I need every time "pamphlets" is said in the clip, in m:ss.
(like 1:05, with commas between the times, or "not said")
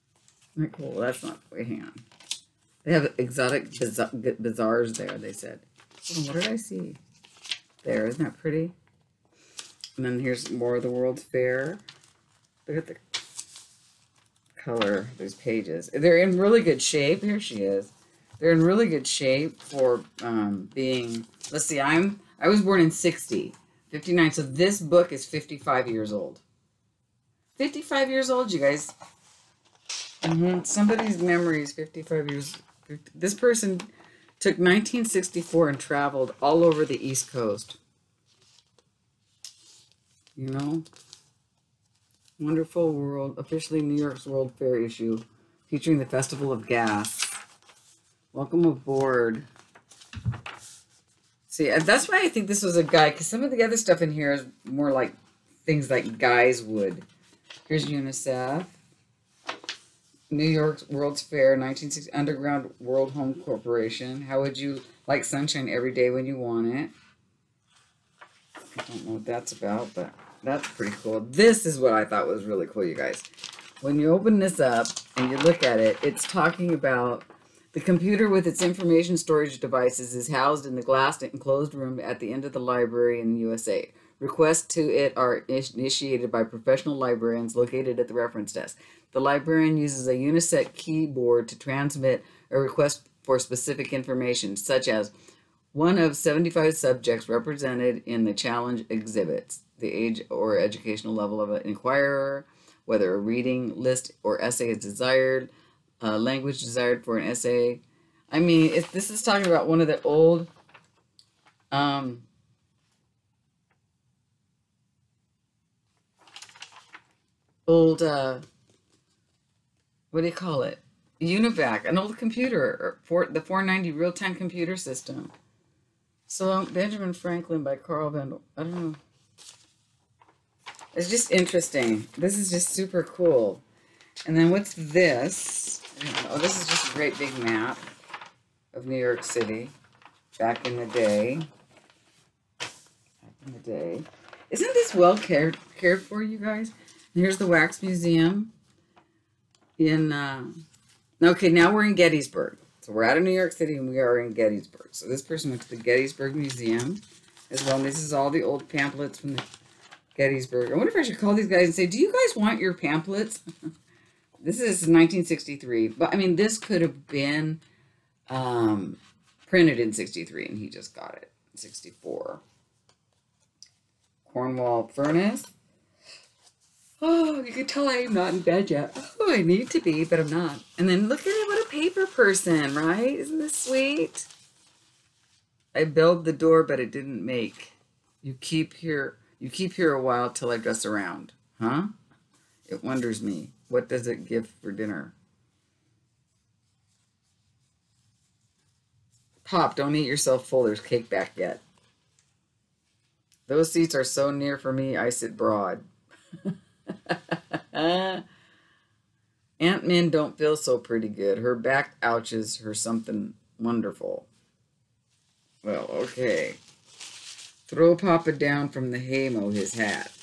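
2:38, 2:42.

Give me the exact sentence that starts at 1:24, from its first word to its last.
Requests to it are initiated by professional librarians located at the reference desk.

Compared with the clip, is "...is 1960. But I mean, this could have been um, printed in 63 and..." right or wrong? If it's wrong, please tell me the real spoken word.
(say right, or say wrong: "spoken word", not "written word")
wrong: "1963", not "1960".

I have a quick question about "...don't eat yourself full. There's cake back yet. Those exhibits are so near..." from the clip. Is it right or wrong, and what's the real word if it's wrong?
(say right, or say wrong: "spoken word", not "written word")
wrong: "seats", not "exhibits".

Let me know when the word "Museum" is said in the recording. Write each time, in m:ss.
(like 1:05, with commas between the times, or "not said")
2:27, 2:36.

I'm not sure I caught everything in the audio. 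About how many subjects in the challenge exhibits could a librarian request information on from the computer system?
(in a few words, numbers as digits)
75.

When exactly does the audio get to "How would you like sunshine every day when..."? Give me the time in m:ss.
1:04.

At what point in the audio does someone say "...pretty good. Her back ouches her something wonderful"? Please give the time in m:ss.
3:30.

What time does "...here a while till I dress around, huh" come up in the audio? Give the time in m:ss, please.
3:09.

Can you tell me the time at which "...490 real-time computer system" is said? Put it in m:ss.
2:03.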